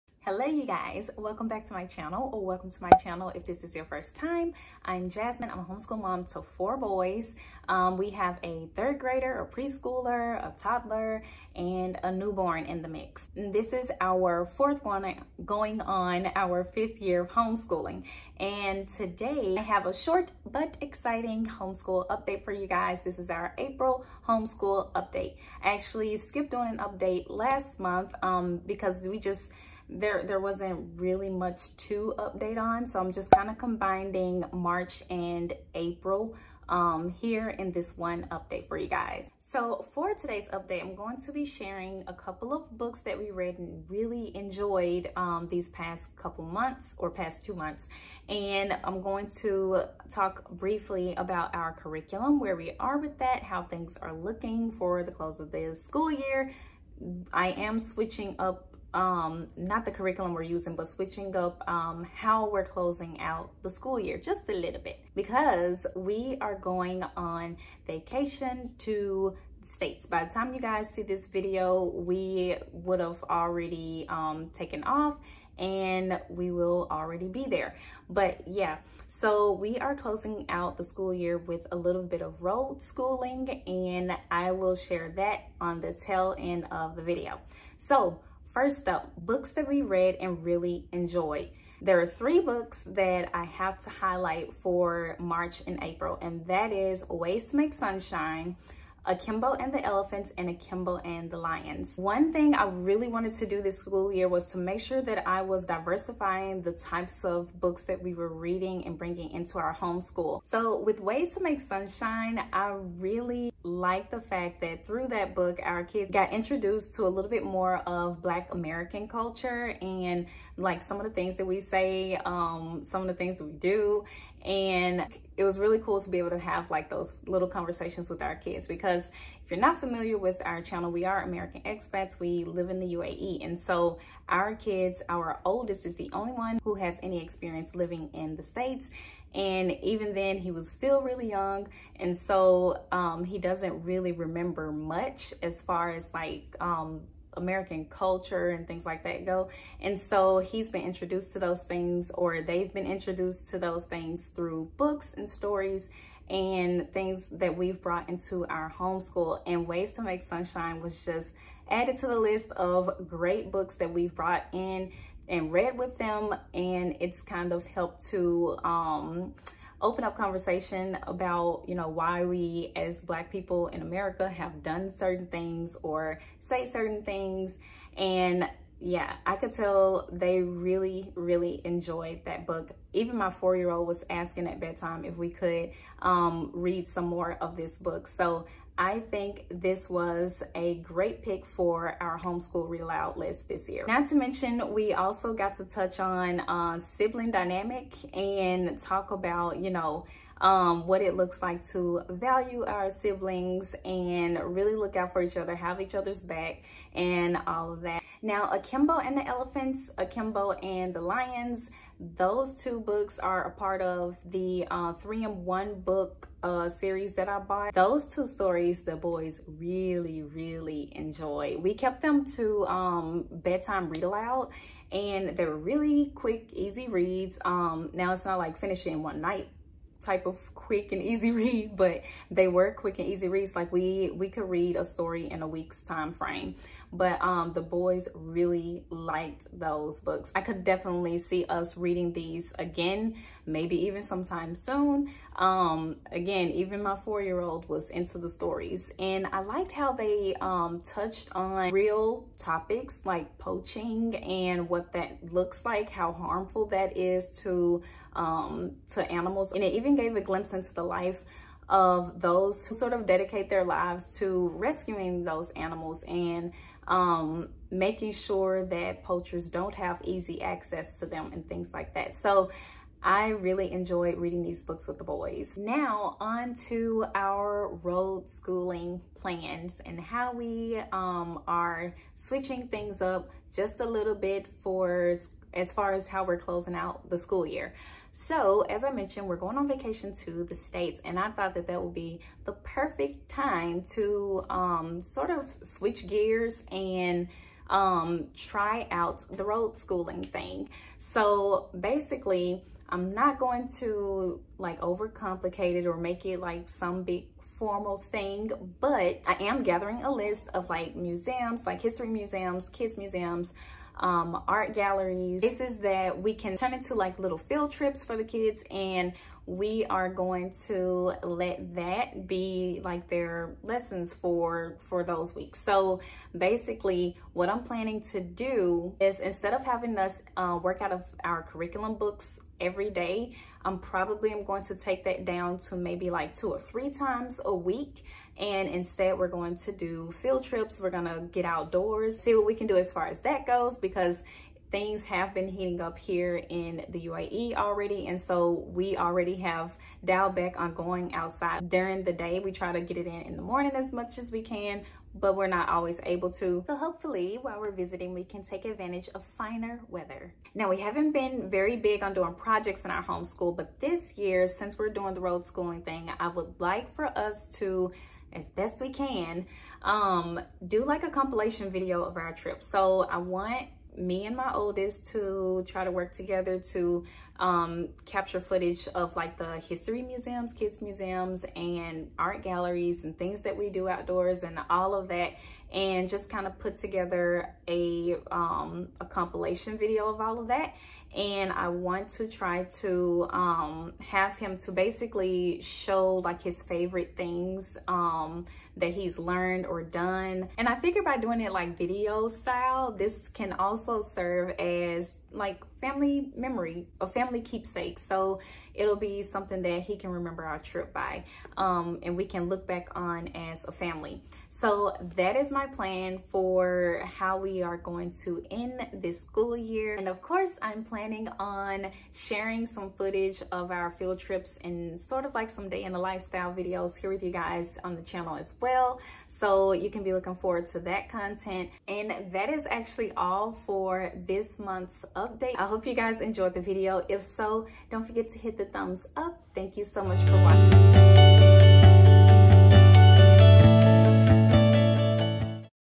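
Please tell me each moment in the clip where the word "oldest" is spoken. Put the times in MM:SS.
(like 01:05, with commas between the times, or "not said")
02:15, 06:14.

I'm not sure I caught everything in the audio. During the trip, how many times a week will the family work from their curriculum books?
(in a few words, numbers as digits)
2 or 3.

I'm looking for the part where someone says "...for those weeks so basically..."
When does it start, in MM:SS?
05:24.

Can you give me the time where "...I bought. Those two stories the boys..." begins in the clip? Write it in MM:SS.
03:37.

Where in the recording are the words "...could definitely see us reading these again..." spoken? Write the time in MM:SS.
04:00.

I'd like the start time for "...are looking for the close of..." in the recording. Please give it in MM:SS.
00:54.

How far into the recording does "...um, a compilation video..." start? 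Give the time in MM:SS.
06:28.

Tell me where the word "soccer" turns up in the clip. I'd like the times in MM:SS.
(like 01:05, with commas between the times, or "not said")
not said.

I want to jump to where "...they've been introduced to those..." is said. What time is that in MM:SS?
02:32.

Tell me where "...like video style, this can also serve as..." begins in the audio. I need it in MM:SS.
06:41.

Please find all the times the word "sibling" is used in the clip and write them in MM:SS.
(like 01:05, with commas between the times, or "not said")
03:16, 03:22.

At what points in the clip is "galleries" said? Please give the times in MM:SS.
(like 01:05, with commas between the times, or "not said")
05:14, 06:22.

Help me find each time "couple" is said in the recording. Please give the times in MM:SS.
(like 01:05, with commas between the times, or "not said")
00:42, 00:46.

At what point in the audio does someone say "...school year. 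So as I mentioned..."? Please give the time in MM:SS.
04:47.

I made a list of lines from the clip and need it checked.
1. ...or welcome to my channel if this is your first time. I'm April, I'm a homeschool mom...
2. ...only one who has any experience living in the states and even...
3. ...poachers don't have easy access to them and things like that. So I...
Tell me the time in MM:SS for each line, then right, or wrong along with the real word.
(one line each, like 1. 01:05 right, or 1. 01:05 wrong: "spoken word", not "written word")
1. 00:02 wrong: "Jasmine", not "April"
2. 02:16 right
3. 04:29 right.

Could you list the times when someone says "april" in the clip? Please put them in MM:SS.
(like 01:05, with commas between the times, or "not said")
00:23, 00:35, 01:35.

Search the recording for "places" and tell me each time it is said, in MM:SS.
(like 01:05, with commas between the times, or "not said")
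05:15.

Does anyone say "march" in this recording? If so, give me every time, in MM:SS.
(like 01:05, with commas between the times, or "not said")
00:34, 01:35.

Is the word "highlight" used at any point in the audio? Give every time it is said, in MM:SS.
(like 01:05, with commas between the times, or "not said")
01:33.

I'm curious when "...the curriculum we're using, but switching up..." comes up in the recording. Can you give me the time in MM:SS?
00:59.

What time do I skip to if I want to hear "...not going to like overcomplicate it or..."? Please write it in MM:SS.
05:03.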